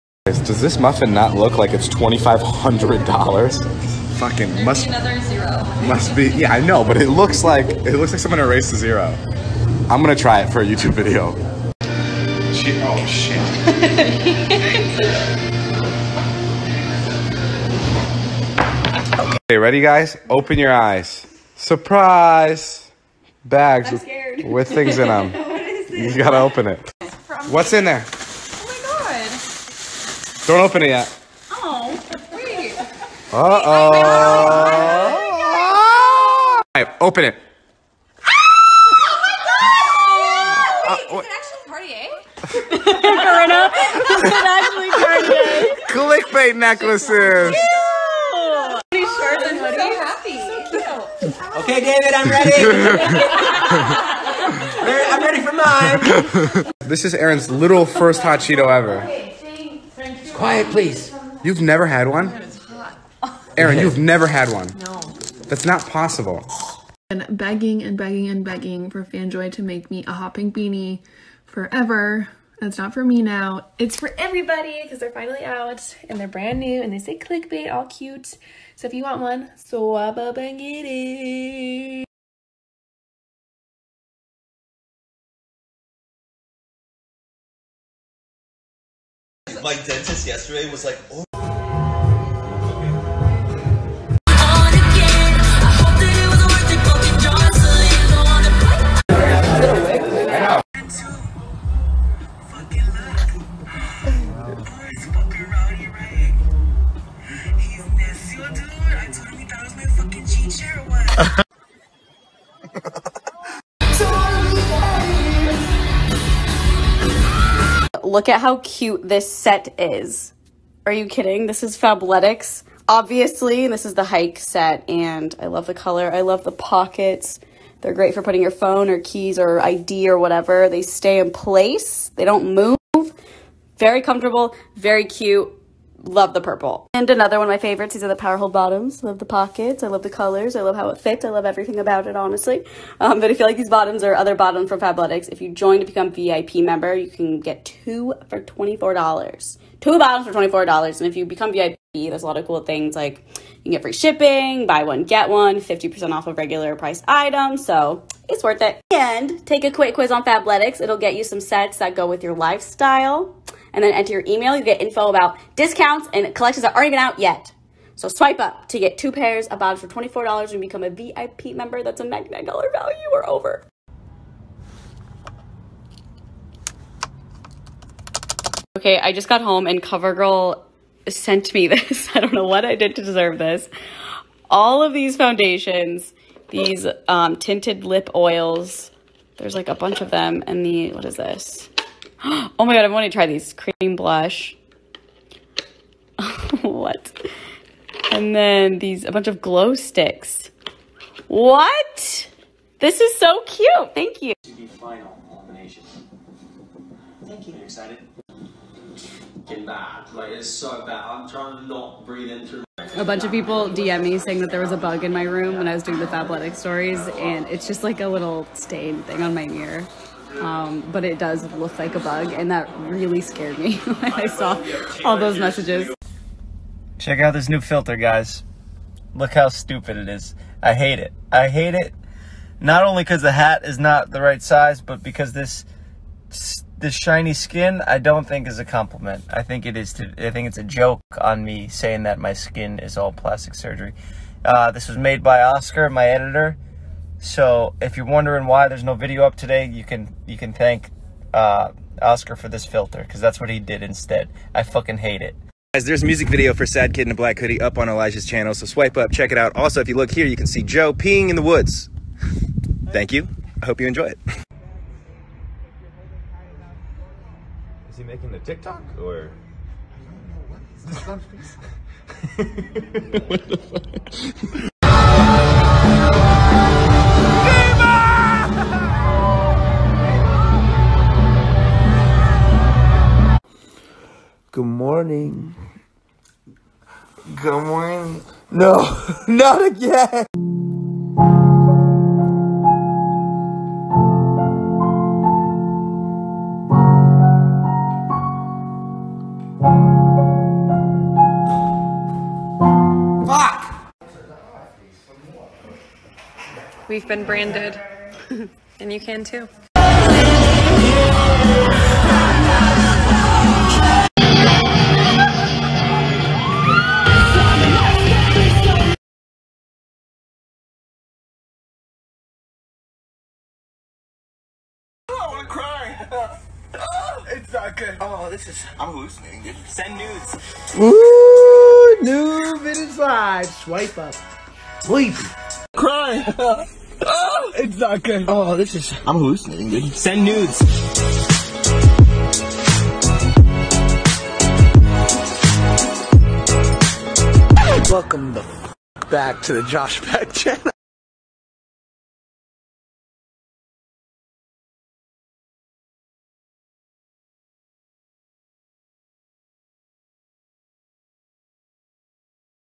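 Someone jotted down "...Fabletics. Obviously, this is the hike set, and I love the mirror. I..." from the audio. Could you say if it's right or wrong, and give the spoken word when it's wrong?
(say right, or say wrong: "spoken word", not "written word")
wrong: "color", not "mirror".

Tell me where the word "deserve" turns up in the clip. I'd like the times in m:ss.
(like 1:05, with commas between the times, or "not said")
3:03.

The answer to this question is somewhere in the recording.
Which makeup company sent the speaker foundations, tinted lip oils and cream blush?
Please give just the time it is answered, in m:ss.
2:59.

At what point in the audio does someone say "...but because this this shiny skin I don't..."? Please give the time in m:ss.
3:54.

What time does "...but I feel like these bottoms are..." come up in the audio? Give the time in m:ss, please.
2:23.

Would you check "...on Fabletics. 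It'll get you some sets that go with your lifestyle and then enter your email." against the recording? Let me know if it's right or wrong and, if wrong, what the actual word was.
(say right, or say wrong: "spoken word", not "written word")
right.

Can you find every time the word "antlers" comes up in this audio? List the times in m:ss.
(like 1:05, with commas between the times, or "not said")
not said.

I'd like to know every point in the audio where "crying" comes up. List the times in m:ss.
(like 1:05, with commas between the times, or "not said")
not said.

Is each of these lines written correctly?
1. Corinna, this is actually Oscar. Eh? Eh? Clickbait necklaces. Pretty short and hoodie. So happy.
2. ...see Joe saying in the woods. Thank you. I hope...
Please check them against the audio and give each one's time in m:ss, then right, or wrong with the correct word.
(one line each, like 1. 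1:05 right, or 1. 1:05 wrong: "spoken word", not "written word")
1. 0:43 wrong: "Kanye", not "Oscar"
2. 4:20 wrong: "peeing", not "saying".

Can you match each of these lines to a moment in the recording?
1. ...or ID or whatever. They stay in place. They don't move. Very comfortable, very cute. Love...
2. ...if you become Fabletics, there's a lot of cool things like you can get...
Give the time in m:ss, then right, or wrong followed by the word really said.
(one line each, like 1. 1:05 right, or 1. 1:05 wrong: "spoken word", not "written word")
1. 2:09 right
2. 2:31 wrong: "VIP", not "Fabletics".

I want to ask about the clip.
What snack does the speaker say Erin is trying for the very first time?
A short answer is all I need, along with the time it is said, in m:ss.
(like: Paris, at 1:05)
hot Cheeto, at 0:58.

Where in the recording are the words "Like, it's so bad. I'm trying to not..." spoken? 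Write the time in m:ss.
3:30.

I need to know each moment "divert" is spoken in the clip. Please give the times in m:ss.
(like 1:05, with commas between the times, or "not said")
not said.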